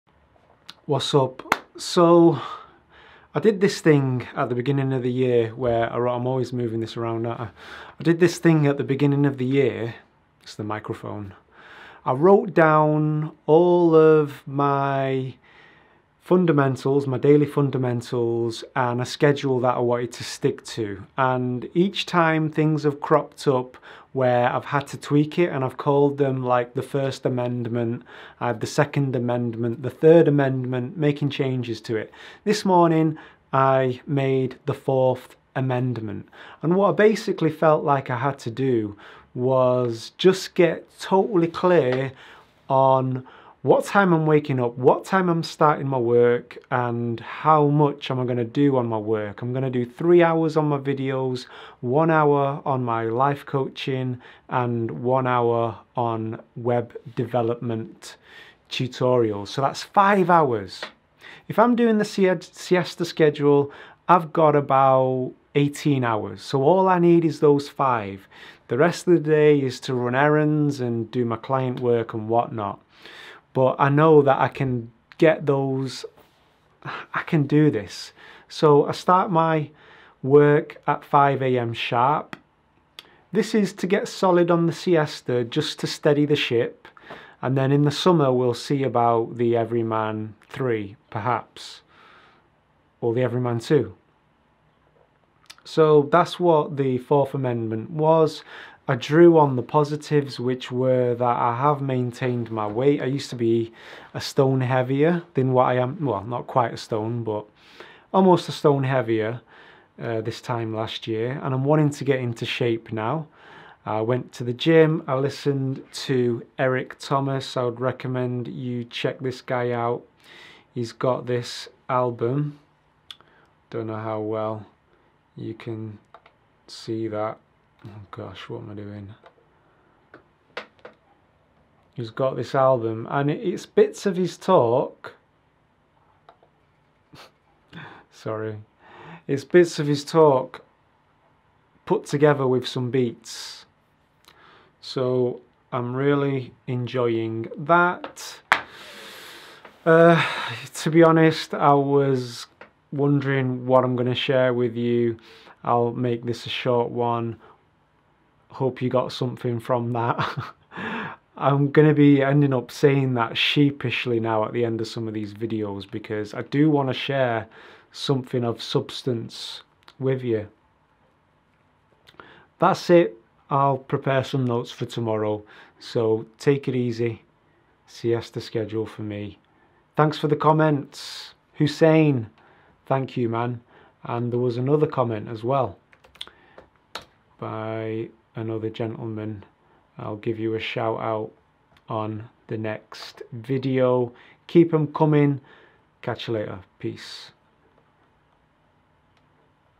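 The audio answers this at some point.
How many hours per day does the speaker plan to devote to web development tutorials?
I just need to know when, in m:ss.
0:54.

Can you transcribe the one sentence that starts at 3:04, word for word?
And there was another comment as well by another gentleman.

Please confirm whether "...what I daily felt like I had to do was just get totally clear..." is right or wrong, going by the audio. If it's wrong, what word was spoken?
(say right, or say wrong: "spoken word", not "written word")
wrong: "basically", not "daily".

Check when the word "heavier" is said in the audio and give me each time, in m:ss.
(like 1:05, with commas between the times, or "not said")
1:44, 1:48.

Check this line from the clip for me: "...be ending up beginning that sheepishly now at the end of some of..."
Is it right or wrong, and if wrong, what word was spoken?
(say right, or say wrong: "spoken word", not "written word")
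wrong: "saying", not "beginning".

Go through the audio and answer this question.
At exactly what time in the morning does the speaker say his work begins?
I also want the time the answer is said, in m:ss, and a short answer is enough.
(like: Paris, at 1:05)
5 a.m., at 1:21.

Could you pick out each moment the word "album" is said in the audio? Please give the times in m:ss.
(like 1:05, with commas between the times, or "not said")
2:01, 2:12.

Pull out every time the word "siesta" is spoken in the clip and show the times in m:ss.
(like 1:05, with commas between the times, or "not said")
1:02, 1:24, 2:57.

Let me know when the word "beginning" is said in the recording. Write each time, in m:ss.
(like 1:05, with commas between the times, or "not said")
0:04, 0:08.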